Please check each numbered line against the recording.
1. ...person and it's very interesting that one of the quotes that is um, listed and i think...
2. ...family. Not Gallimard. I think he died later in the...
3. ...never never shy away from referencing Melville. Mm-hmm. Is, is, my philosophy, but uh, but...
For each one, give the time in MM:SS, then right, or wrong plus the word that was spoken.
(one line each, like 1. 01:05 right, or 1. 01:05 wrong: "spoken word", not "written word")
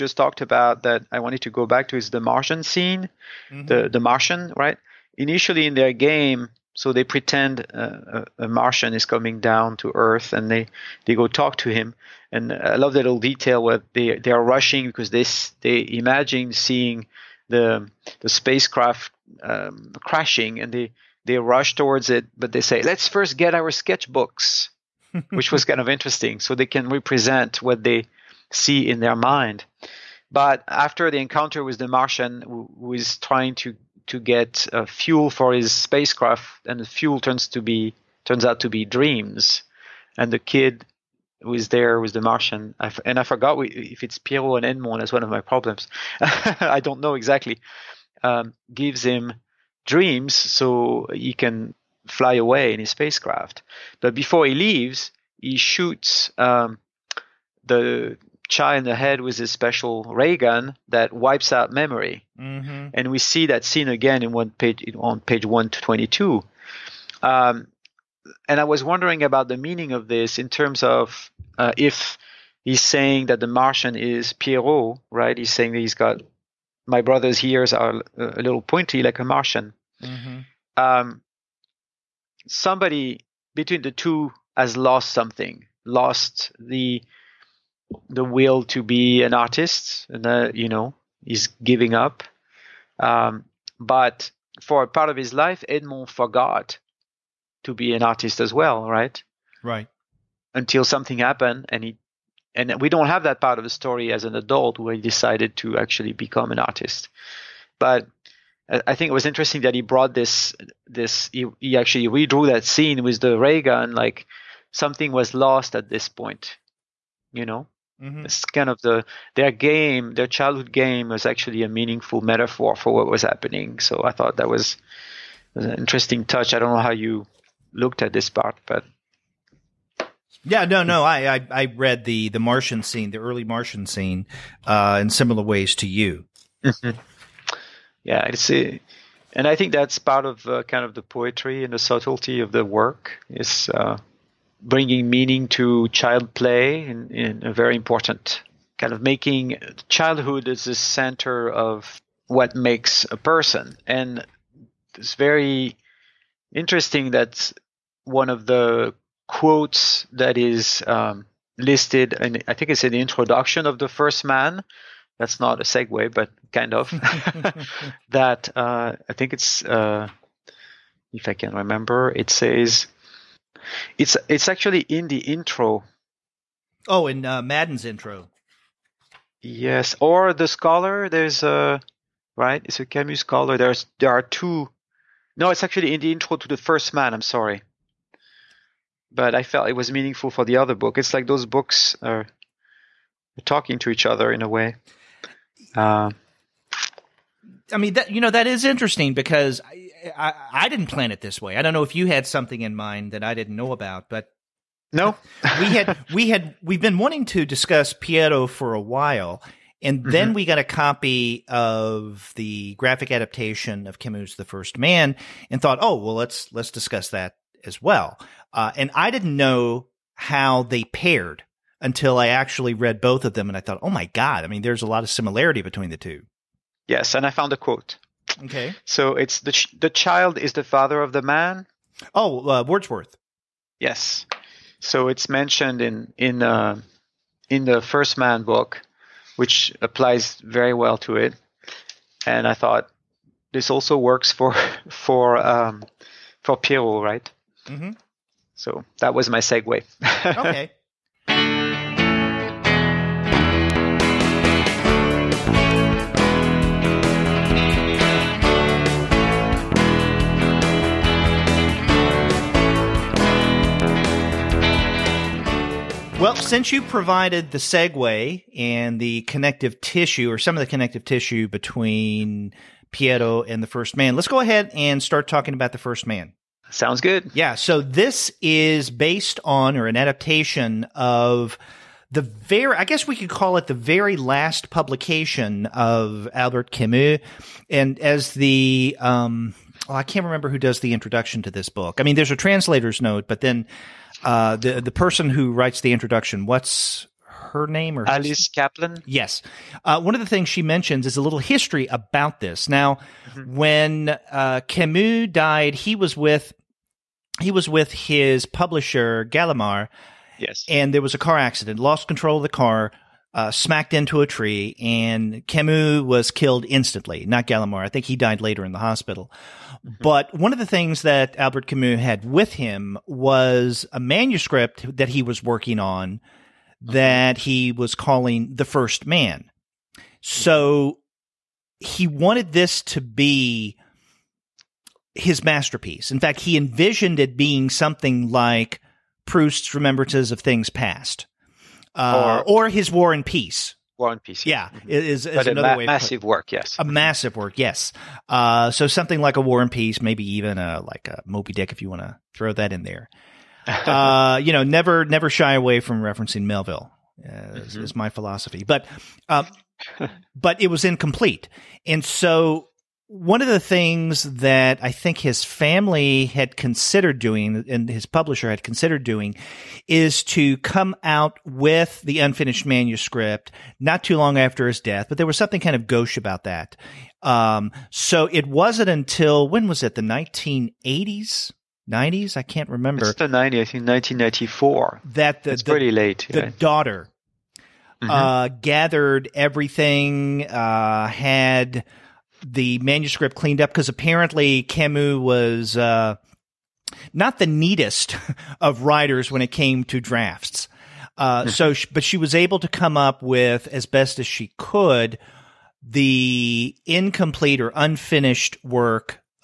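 1. 02:33 right
2. 05:16 wrong: "instantly", not "family"
3. 05:54 right.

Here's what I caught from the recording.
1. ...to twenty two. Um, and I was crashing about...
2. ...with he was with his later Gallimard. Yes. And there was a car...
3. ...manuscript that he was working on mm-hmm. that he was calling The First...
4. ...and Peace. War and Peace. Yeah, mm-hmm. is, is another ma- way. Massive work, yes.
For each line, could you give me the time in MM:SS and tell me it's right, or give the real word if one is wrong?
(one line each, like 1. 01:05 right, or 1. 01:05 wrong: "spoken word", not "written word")
1. 01:05 wrong: "wondering", not "crashing"
2. 05:06 wrong: "publisher", not "later"
3. 05:23 right
4. 05:43 right.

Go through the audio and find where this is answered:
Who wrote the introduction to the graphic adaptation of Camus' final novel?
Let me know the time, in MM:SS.
04:58.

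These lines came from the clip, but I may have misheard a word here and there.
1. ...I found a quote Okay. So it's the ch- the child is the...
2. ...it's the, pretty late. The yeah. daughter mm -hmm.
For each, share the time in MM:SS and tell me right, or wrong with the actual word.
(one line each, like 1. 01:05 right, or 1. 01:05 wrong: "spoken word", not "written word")
1. 03:47 right
2. 06:25 right.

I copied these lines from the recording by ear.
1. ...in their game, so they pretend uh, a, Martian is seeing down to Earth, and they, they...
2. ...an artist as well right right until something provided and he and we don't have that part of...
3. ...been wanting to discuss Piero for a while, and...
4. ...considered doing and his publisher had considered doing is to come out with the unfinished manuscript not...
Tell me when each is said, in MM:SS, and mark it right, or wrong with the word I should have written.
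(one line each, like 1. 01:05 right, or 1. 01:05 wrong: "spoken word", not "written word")
1. 00:05 wrong: "coming", not "seeing"
2. 01:37 wrong: "happened", not "provided"
3. 03:26 right
4. 06:06 right.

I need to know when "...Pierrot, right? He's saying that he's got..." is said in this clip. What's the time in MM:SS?
01:14.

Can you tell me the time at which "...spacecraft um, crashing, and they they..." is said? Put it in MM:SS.
00:18.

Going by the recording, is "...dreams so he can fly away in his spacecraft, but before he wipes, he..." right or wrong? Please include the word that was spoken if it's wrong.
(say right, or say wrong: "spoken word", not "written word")
wrong: "leaves", not "wipes".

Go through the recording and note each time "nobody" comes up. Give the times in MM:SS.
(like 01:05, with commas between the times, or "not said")
not said.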